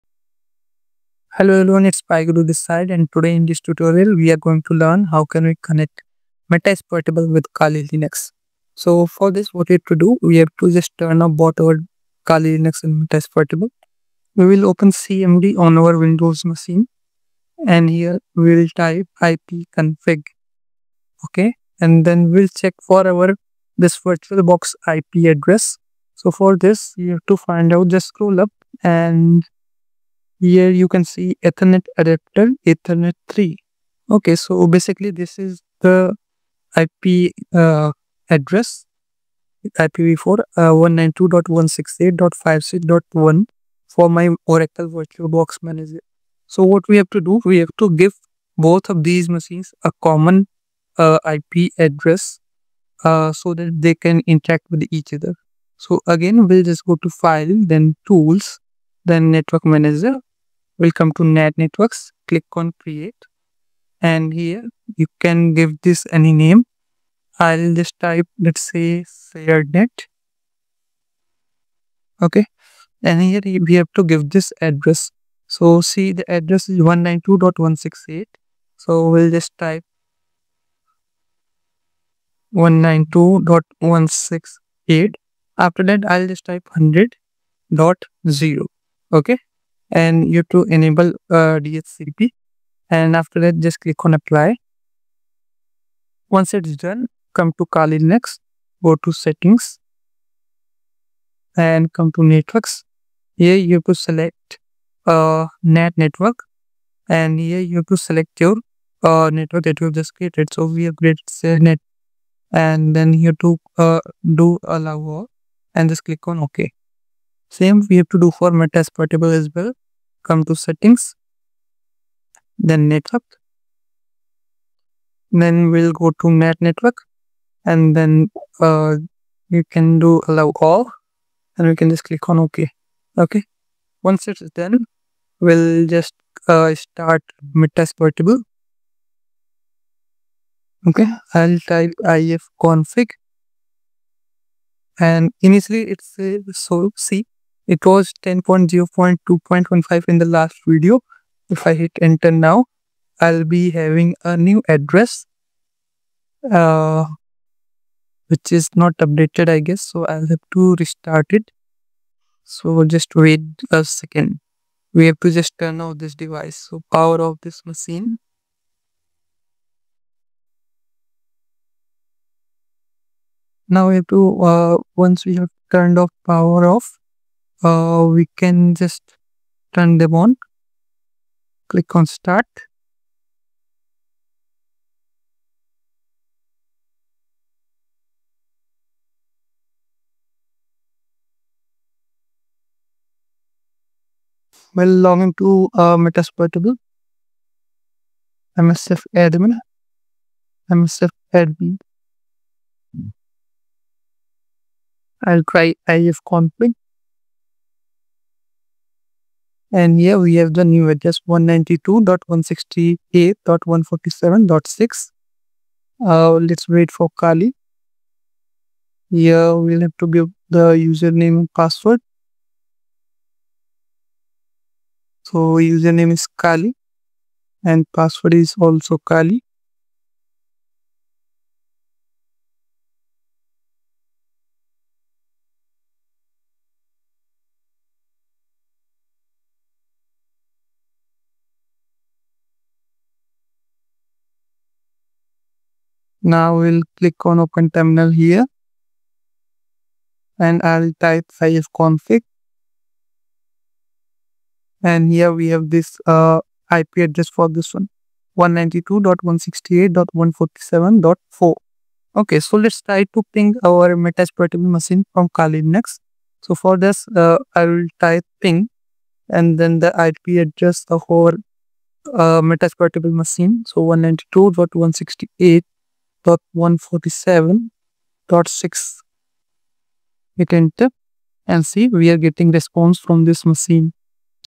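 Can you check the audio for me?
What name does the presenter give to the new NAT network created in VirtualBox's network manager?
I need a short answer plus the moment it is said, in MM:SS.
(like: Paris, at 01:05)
shared net, at 01:09.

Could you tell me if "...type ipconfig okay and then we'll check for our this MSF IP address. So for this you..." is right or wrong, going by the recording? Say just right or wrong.
wrong.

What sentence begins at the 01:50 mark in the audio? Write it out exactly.
So we have created say net and then you have to uh, do allow all and just click on OK.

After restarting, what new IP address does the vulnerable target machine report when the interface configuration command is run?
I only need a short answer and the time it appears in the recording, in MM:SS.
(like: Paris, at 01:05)
192.168.147.6, at 03:31.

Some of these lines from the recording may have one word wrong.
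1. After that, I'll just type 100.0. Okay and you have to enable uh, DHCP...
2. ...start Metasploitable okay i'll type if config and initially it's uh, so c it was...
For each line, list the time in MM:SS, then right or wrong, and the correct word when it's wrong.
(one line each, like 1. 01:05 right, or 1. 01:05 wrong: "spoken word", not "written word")
1. 01:25 right
2. 02:16 right.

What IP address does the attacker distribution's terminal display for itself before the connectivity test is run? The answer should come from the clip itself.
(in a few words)
192.168.147.4.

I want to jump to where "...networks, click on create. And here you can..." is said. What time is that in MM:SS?
01:01.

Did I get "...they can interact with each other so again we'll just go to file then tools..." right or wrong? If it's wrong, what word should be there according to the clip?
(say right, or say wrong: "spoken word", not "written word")
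right.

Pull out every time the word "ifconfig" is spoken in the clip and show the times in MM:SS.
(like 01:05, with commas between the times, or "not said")
03:25, 04:11.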